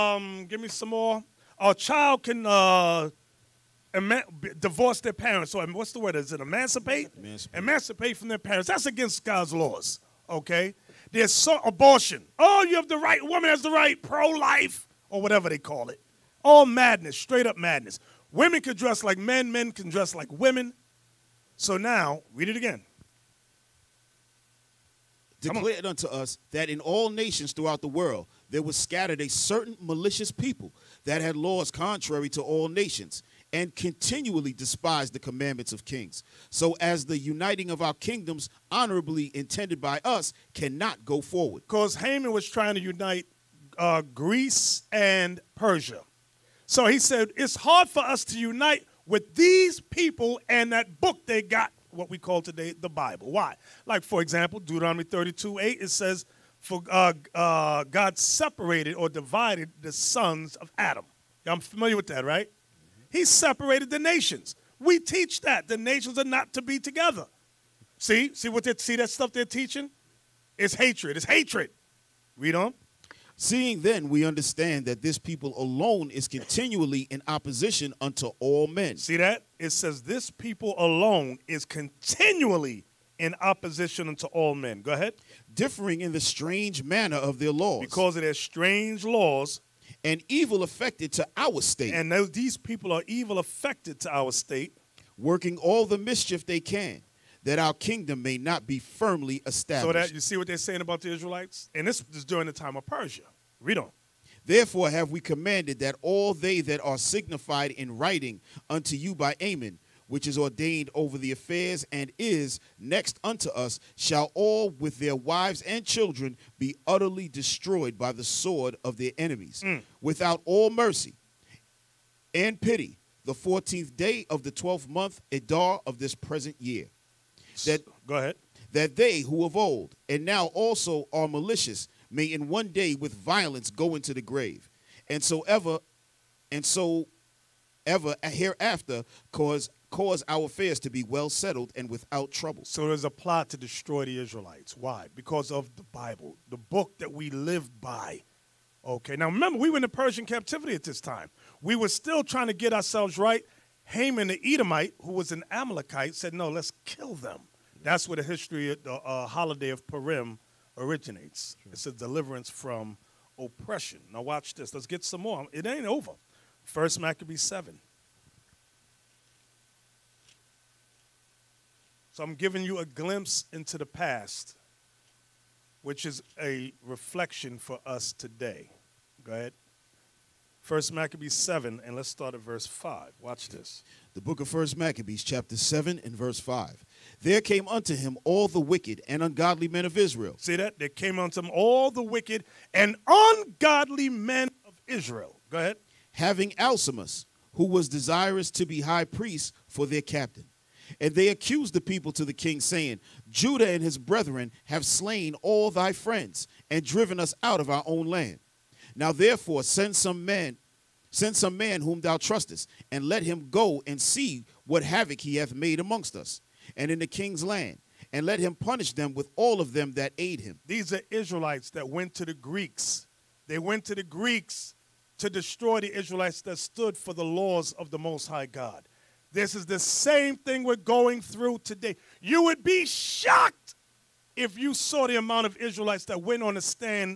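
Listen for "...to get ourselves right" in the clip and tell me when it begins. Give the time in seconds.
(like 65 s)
152 s.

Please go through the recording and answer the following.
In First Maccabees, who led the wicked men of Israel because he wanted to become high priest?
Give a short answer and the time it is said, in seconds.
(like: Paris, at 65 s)
Alcimus, at 196 s.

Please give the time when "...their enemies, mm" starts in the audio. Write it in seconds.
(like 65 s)
118 s.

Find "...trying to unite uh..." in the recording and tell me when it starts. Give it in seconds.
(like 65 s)
42 s.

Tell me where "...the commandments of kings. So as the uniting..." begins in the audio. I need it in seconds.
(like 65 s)
35 s.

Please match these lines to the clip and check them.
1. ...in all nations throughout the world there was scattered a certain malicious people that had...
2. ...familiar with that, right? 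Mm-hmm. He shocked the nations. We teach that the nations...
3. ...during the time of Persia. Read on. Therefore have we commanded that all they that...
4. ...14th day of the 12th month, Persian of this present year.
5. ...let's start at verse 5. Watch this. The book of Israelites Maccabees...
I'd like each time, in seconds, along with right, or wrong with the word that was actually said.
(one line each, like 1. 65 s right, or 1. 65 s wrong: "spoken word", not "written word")
1. 26 s right
2. 61 s wrong: "separated", not "shocked"
3. 102 s right
4. 123 s wrong: "Adar", not "Persian"
5. 181 s wrong: "First", not "Israelites".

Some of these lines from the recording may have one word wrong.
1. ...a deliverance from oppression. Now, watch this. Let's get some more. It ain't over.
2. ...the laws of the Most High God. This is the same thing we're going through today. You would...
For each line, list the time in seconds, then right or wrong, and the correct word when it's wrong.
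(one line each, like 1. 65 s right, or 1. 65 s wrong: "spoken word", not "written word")
1. 161 s right
2. 227 s right.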